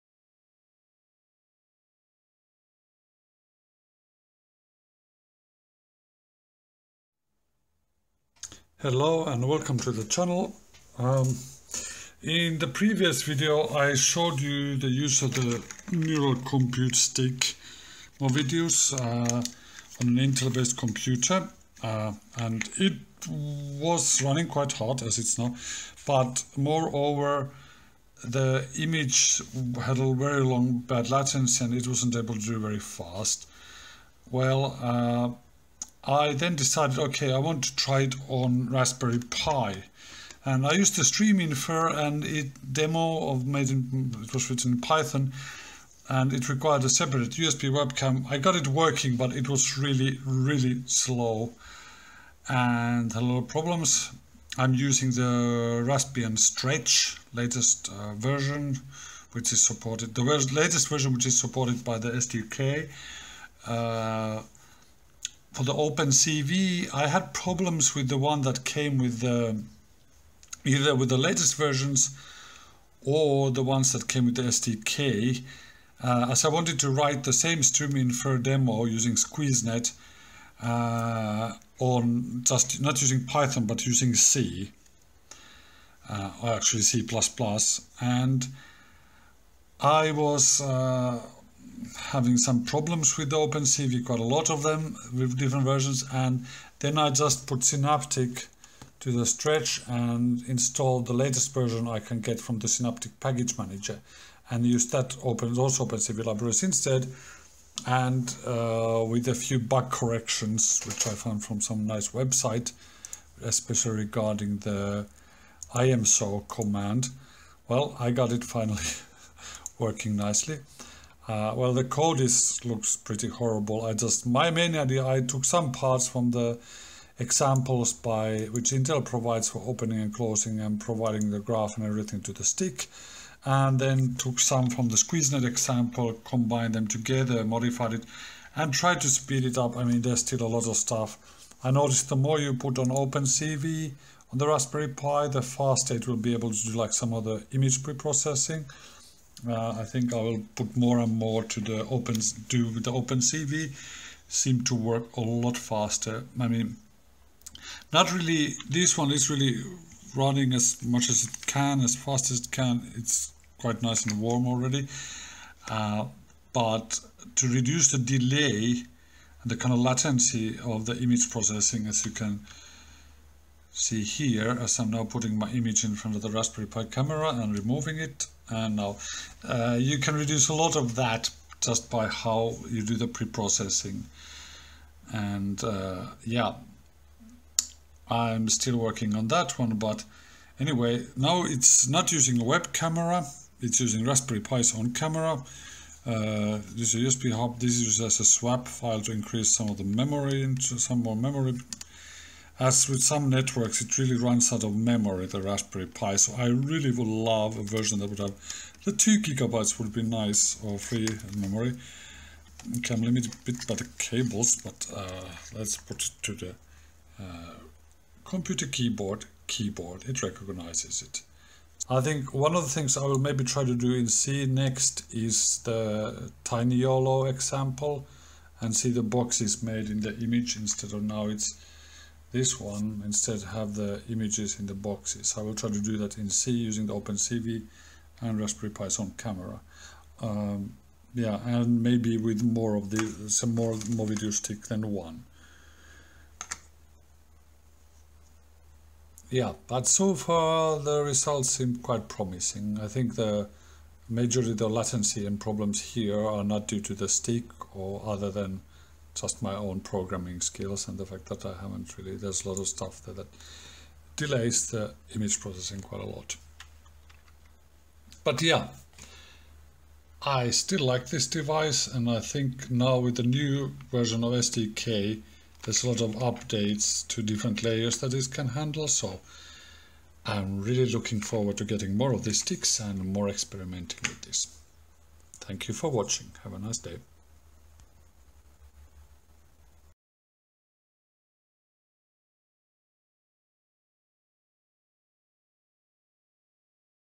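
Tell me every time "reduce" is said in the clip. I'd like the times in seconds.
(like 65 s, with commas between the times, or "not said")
167 s, 180 s.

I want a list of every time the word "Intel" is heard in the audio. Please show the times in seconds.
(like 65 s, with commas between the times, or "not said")
20 s, 128 s.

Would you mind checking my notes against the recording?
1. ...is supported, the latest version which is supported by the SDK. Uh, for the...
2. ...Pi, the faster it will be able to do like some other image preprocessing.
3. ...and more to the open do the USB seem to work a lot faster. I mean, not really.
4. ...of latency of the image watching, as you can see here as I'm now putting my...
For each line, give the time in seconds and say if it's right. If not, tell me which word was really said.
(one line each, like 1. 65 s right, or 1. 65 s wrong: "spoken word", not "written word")
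1. 59 s right
2. 144 s right
3. 150 s wrong: "OpenCV", not "USB"
4. 169 s wrong: "processing", not "watching".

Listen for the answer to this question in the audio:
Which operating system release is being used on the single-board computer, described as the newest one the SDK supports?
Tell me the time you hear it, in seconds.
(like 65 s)
55 s.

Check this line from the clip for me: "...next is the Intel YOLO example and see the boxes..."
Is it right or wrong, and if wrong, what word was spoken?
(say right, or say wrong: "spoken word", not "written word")
wrong: "Tiny", not "Intel".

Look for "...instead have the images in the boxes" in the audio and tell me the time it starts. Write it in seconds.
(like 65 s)
233 s.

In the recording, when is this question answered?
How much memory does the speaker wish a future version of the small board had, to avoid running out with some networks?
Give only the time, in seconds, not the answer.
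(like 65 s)
208 s.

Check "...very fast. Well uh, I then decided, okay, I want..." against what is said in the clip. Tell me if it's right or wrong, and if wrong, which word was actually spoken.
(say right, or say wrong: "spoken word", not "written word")
right.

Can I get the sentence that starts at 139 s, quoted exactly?
I mean, there's still a lot of stuff.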